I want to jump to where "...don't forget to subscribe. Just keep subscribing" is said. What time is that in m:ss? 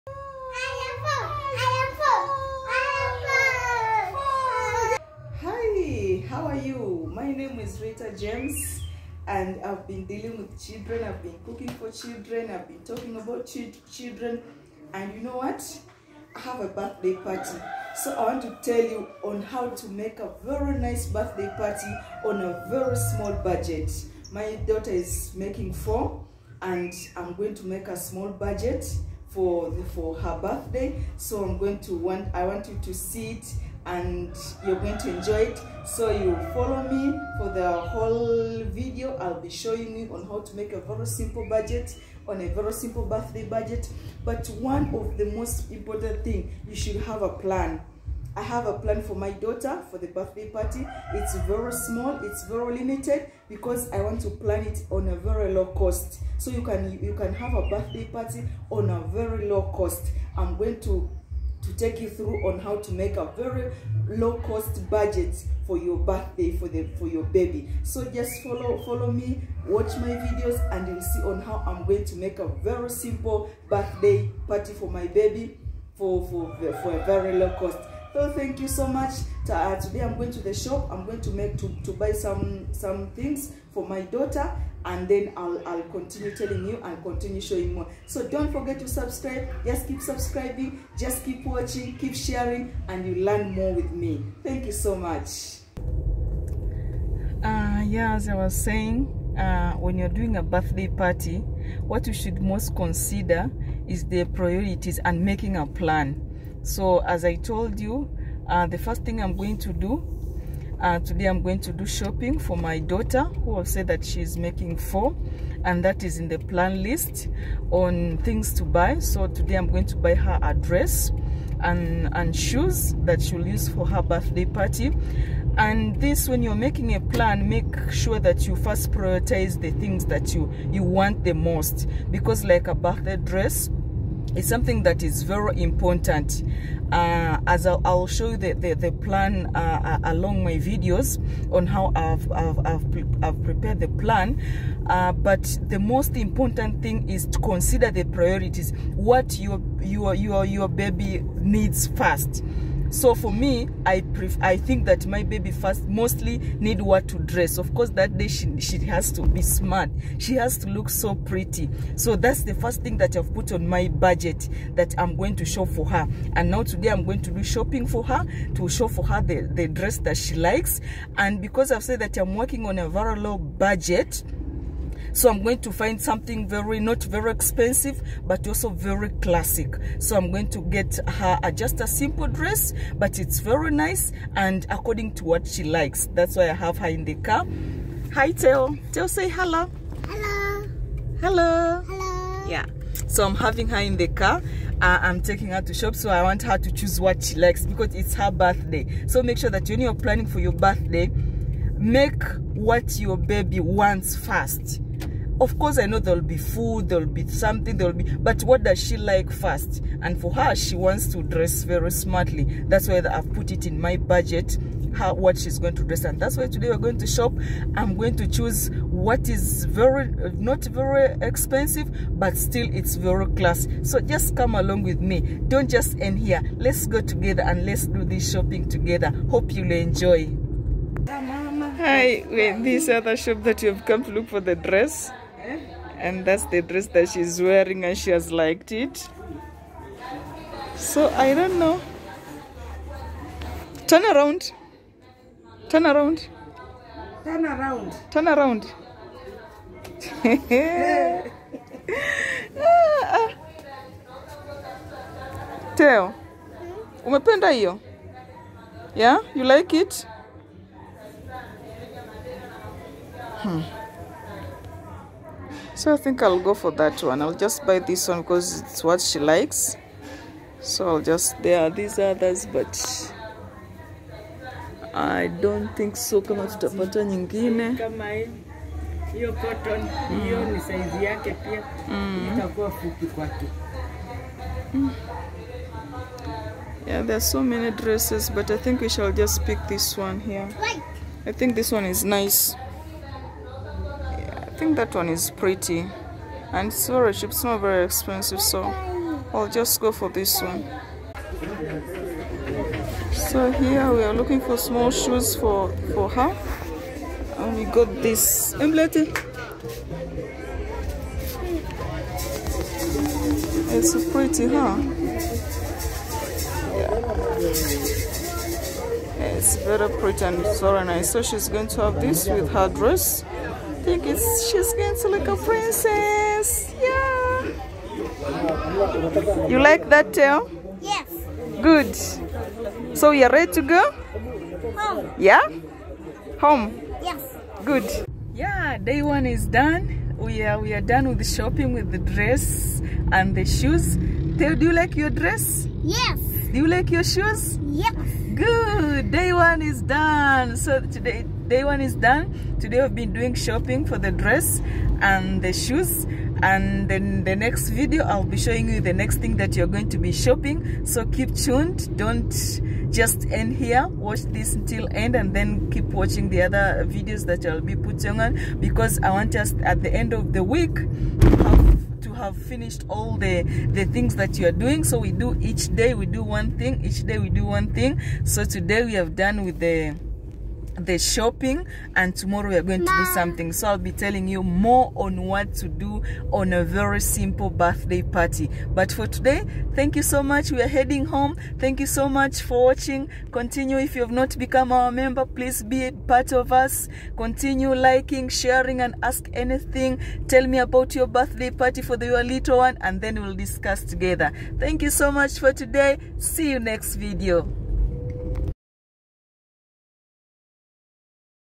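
1:28.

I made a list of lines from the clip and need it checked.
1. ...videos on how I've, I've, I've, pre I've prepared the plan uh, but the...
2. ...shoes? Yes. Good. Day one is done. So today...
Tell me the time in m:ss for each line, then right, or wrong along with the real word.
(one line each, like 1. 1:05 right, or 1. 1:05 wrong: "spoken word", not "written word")
1. 2:20 right
2. 5:47 right.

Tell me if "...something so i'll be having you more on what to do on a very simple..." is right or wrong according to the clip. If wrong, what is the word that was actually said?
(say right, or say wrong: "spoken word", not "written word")
wrong: "telling", not "having".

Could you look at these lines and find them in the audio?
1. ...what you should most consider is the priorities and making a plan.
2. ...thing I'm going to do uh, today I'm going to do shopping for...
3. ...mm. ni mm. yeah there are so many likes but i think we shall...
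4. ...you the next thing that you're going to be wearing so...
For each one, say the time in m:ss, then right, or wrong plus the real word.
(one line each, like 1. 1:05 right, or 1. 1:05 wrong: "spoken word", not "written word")
1. 1:41 right
2. 1:49 right
3. 4:40 wrong: "dresses", not "likes"
4. 5:58 wrong: "shopping", not "wearing".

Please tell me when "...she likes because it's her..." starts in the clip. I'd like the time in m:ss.
3:17.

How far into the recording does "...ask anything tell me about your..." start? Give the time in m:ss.
6:39.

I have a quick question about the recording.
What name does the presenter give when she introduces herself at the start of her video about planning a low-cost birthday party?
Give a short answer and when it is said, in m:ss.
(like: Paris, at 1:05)
Ritha James, at 0:07.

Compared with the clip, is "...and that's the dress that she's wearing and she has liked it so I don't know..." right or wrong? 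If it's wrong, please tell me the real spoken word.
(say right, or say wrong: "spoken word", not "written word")
right.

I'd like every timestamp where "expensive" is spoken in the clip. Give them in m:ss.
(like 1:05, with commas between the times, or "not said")
2:57, 3:41, 4:57.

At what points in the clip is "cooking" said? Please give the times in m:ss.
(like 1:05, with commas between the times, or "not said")
0:11.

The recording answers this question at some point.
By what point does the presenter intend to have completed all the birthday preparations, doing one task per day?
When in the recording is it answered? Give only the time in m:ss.
6:09.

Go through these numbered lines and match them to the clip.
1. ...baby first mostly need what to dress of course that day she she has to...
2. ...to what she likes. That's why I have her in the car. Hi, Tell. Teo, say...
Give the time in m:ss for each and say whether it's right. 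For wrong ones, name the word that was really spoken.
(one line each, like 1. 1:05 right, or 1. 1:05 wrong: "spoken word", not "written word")
1. 2:35 right
2. 3:05 wrong: "Teo", not "Tell".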